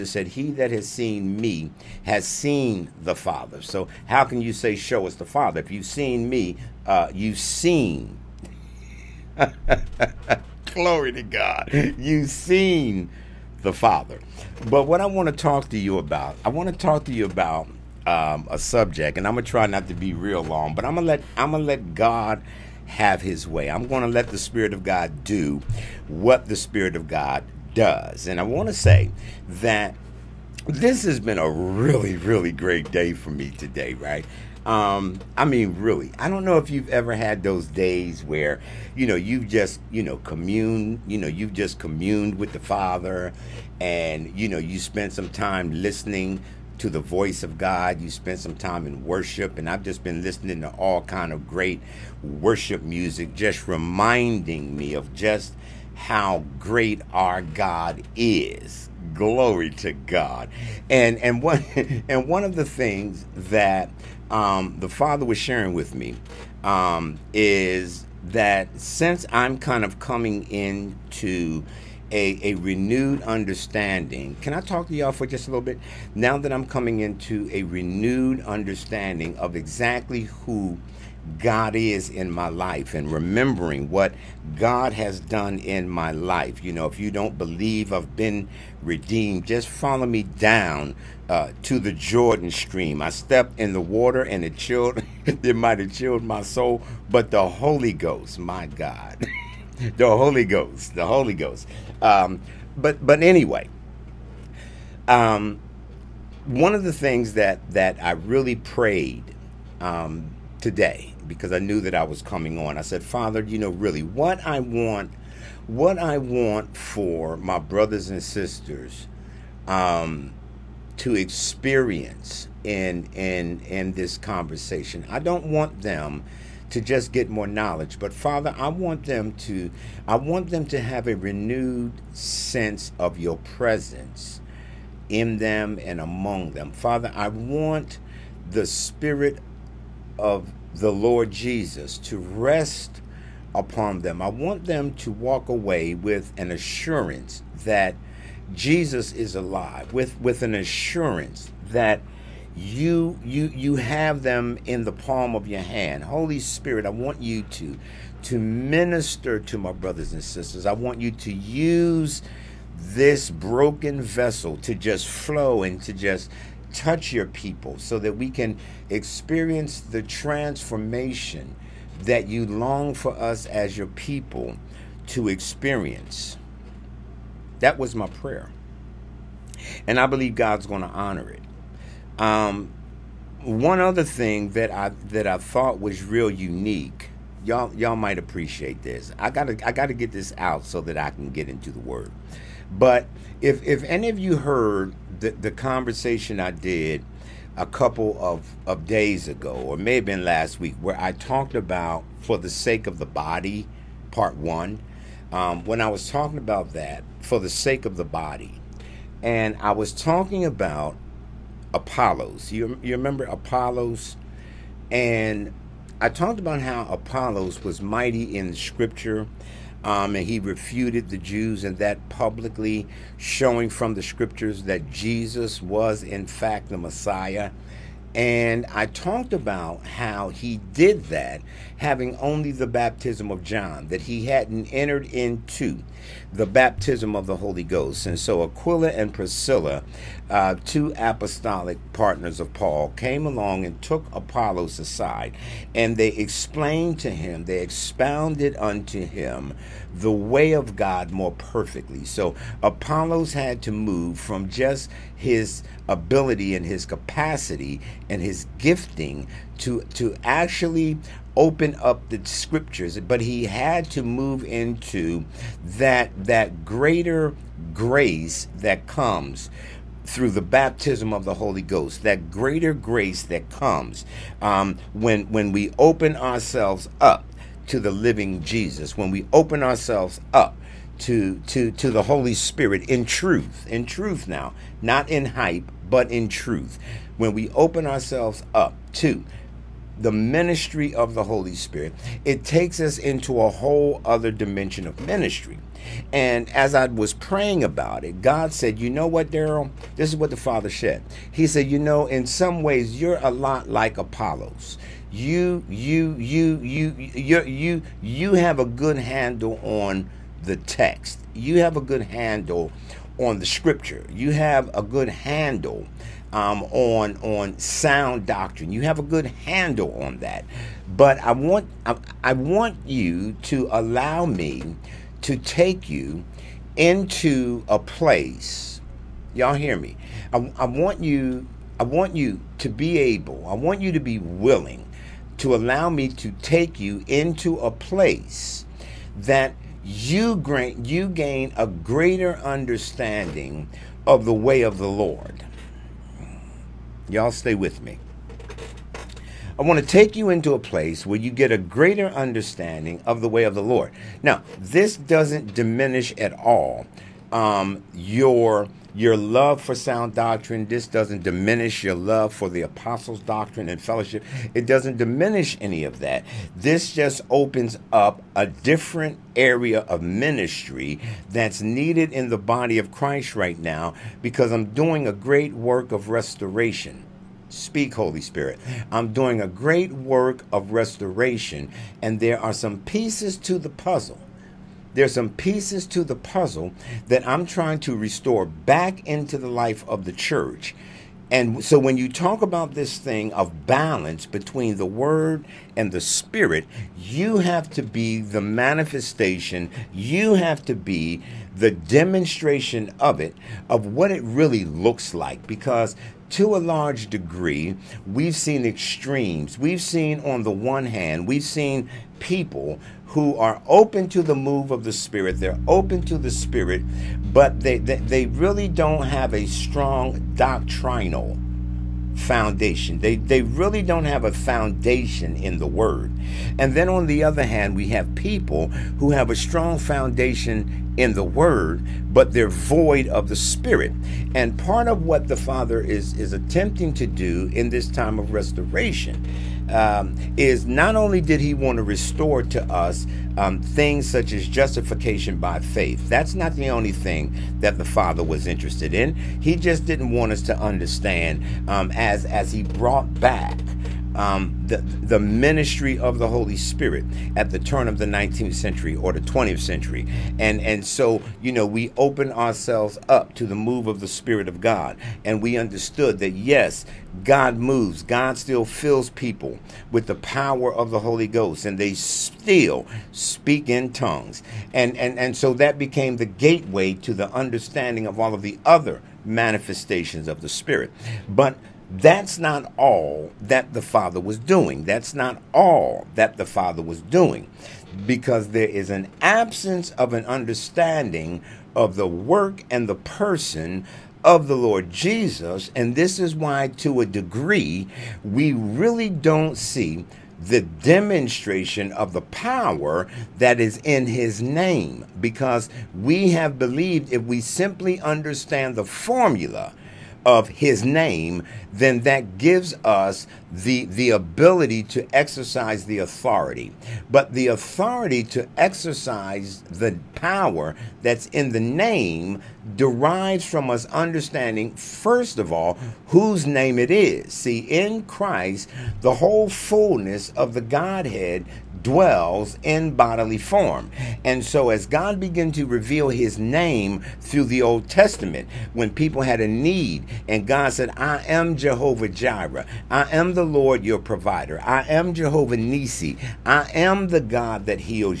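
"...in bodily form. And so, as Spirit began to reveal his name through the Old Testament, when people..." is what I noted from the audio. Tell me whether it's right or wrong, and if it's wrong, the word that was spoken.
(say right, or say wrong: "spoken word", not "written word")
wrong: "God", not "Spirit".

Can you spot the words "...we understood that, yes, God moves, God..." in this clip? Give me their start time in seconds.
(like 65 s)
465 s.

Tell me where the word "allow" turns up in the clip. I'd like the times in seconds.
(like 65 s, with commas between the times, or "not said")
323 s, 335 s.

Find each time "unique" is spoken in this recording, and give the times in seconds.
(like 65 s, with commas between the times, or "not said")
186 s.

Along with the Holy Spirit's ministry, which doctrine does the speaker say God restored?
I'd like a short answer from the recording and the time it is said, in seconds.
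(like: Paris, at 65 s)
Justification by faith, at 444 s.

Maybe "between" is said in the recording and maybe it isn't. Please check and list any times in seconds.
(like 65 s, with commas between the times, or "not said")
394 s.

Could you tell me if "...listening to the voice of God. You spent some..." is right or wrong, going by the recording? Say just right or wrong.
right.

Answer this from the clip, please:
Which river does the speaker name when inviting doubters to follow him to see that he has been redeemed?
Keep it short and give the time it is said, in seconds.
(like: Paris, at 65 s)
Jordan, at 91 s.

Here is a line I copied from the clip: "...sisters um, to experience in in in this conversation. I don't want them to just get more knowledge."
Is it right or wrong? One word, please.
right.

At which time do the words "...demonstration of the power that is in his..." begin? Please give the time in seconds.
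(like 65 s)
500 s.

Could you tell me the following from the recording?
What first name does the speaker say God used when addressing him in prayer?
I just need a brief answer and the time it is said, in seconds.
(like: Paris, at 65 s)
Daryl, at 299 s.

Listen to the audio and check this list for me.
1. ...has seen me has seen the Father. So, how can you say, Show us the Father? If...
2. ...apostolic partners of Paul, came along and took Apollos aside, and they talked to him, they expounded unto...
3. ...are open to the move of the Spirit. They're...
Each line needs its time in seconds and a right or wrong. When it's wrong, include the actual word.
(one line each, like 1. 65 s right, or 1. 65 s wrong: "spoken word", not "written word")
1. 0 s right
2. 240 s wrong: "explained", not "talked"
3. 413 s right.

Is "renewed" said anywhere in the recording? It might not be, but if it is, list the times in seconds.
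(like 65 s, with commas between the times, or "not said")
72 s, 77 s, 131 s.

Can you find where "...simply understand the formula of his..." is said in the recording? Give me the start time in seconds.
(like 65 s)
507 s.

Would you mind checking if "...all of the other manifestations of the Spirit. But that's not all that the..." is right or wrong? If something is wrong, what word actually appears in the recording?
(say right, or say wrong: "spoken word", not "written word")
right.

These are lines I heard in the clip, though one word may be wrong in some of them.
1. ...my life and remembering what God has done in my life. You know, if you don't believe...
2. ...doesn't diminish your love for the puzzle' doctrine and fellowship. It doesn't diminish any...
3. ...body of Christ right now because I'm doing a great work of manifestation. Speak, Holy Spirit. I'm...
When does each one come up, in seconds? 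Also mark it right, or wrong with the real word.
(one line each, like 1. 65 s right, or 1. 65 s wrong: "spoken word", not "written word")
1. 82 s right
2. 360 s wrong: "apostles", not "puzzle"
3. 372 s wrong: "restoration", not "manifestation".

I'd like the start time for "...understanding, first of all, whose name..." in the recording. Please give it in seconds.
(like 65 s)
523 s.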